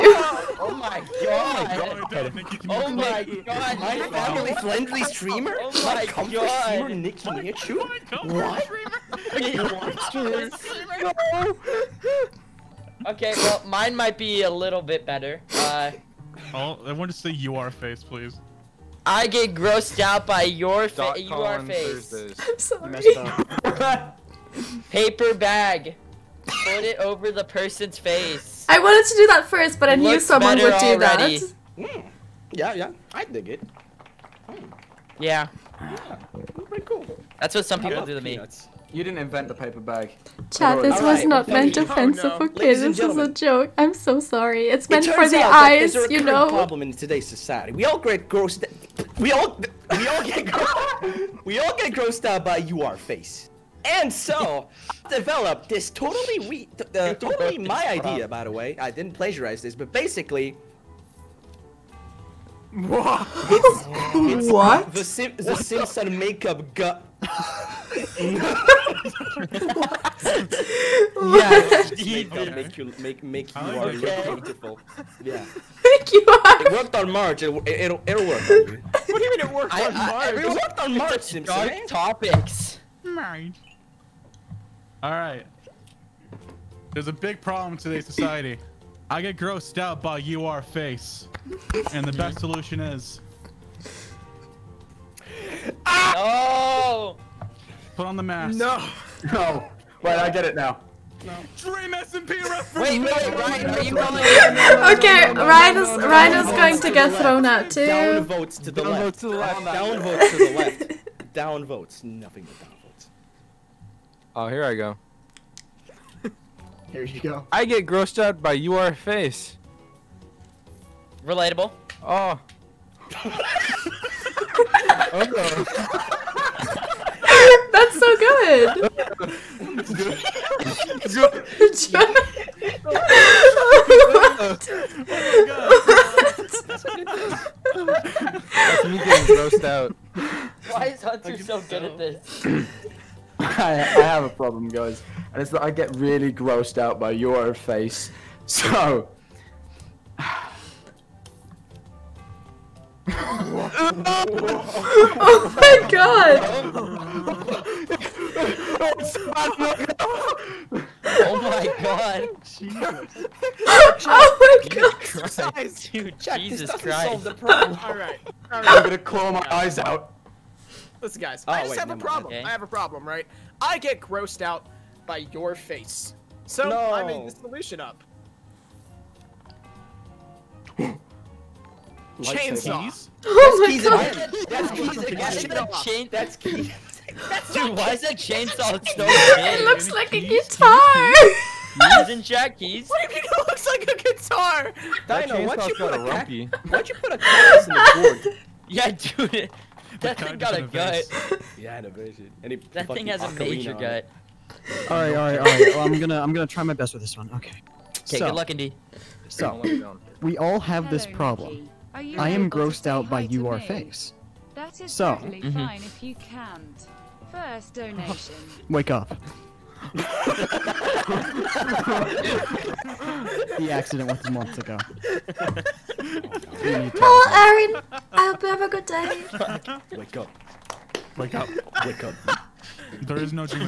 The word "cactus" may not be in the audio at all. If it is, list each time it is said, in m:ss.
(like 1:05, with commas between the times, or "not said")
3:17.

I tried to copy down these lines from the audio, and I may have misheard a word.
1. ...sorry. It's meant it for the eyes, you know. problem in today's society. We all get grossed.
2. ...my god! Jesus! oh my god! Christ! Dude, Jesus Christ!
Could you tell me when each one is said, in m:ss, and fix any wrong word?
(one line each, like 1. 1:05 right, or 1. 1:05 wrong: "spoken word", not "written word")
1. 0:44 right
2. 2:41 right.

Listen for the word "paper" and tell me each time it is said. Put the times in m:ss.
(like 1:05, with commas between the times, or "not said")
0:24, 0:39.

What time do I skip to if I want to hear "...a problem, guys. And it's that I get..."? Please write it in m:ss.
2:24.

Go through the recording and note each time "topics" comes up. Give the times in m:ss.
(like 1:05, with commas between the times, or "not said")
1:21.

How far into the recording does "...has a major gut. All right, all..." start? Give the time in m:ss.
3:23.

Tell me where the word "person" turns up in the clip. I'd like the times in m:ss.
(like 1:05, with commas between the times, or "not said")
0:27.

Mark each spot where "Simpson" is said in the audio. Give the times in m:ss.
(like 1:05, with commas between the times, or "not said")
1:05, 1:21.